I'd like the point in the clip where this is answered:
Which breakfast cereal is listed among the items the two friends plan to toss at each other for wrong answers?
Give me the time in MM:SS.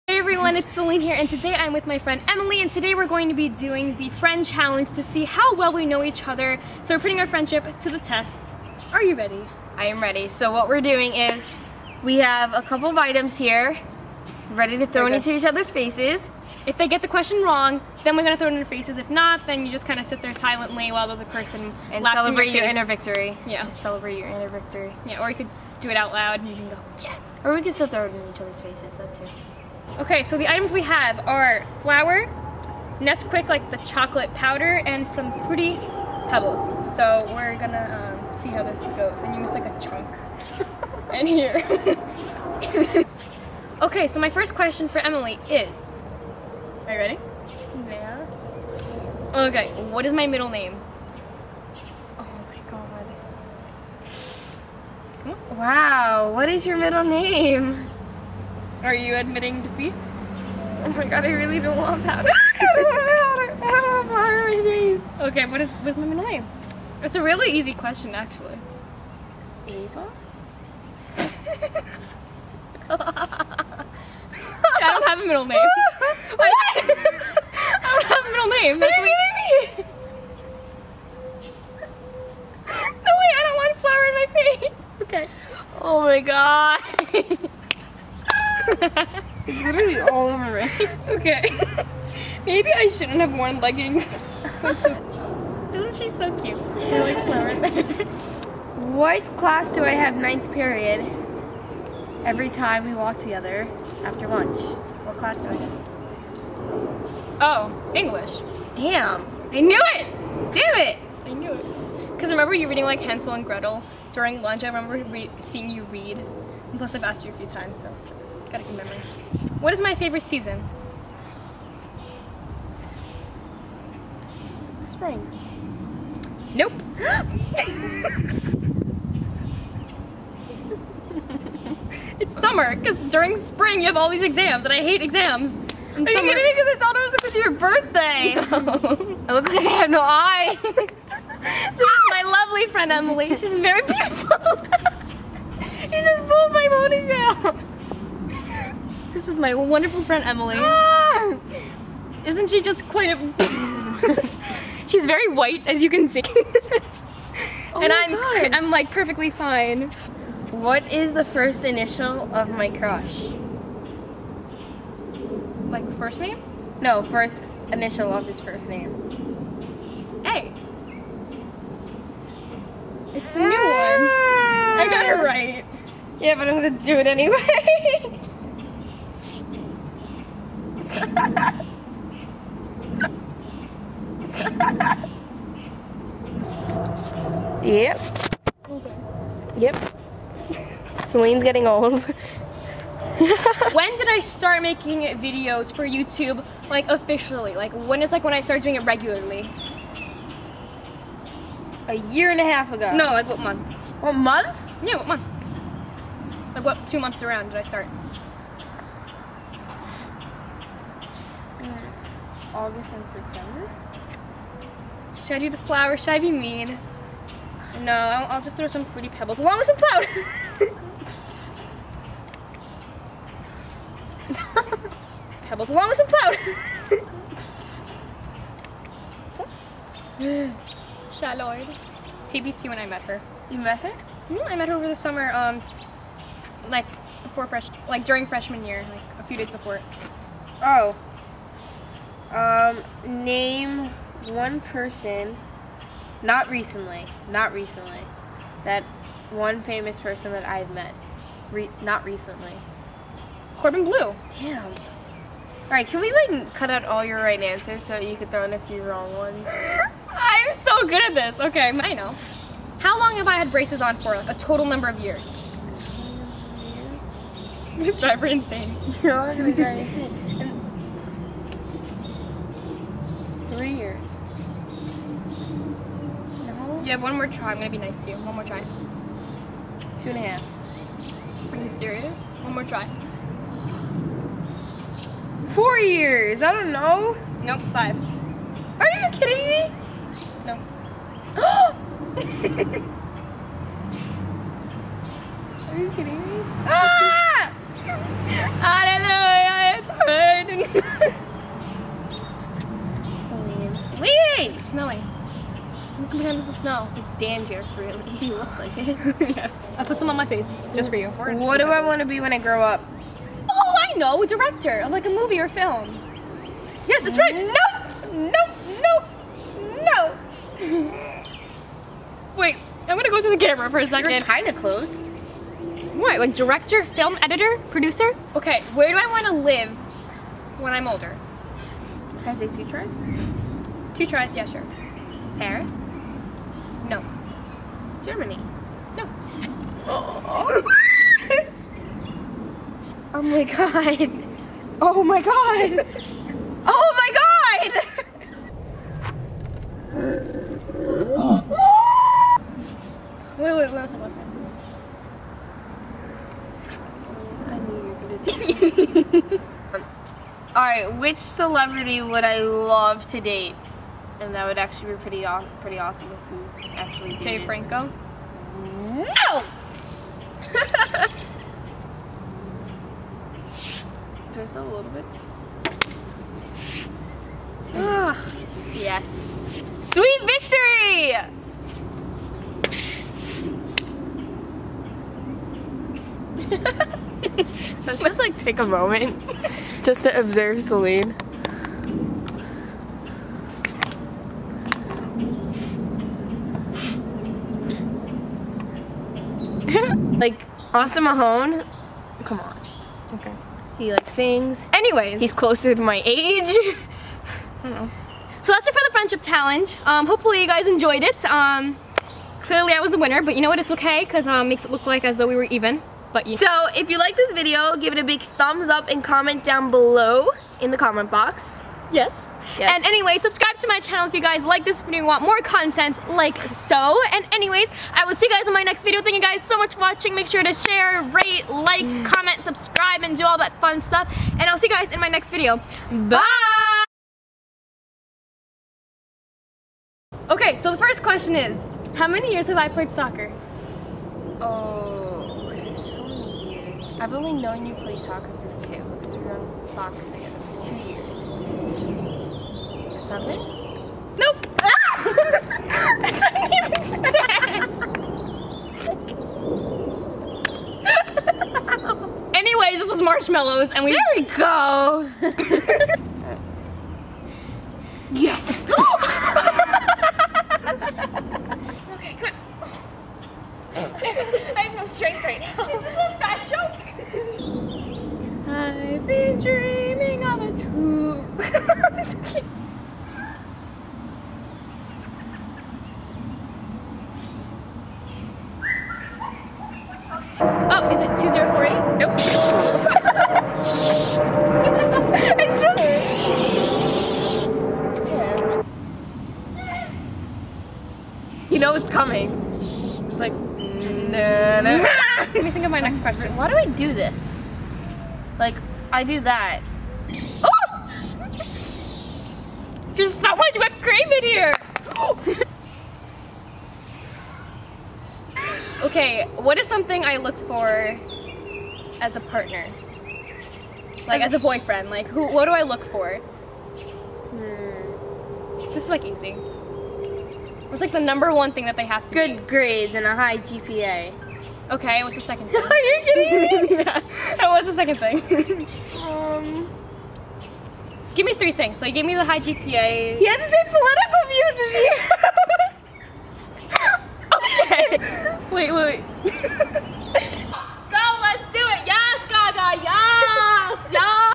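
00:35.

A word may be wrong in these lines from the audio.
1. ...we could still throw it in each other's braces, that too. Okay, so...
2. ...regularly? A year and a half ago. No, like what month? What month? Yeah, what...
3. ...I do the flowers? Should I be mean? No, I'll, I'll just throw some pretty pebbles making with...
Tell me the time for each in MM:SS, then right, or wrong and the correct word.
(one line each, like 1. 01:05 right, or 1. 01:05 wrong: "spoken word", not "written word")
1. 00:27 wrong: "faces", not "braces"
2. 03:18 right
3. 03:35 wrong: "along", not "making".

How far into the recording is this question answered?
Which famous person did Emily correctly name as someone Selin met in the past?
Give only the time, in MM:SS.
04:13.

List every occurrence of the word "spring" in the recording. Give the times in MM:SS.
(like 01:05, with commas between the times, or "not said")
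02:04, 02:13.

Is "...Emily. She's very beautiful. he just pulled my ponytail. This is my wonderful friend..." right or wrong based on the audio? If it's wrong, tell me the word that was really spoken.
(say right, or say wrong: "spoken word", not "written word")
right.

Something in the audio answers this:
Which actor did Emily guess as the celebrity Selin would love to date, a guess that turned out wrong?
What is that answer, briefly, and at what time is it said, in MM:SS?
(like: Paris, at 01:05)
Dave Franco, at 06:07.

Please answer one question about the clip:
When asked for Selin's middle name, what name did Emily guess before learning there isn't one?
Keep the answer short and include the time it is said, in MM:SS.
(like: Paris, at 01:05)
Ava, at 01:09.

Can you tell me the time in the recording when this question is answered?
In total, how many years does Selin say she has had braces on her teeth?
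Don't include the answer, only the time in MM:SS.
04:47.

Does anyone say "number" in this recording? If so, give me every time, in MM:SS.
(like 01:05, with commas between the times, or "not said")
04:24, 08:50.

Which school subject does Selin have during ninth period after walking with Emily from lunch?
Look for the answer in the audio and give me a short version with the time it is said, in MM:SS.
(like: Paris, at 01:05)
English, at 01:47.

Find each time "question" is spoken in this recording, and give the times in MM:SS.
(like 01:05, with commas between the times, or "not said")
00:17, 00:44, 01:07, 07:21, 08:25.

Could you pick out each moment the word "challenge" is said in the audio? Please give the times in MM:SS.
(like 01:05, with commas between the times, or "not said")
00:04, 06:49.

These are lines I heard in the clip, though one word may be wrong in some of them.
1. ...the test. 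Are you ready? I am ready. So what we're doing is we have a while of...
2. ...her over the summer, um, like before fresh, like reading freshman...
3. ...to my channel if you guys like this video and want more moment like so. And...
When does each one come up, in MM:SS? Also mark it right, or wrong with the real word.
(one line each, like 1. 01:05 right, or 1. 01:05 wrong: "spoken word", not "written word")
1. 00:07 wrong: "couple", not "while"
2. 03:54 wrong: "during", not "reading"
3. 07:03 wrong: "content", not "moment".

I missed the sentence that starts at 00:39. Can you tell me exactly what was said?
And you missed like a chunk.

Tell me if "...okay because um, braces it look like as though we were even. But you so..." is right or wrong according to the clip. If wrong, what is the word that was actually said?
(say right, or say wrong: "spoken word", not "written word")
wrong: "makes", not "braces".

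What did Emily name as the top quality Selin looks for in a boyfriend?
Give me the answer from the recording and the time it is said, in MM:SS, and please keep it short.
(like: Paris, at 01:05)
A high GPA, at 08:53.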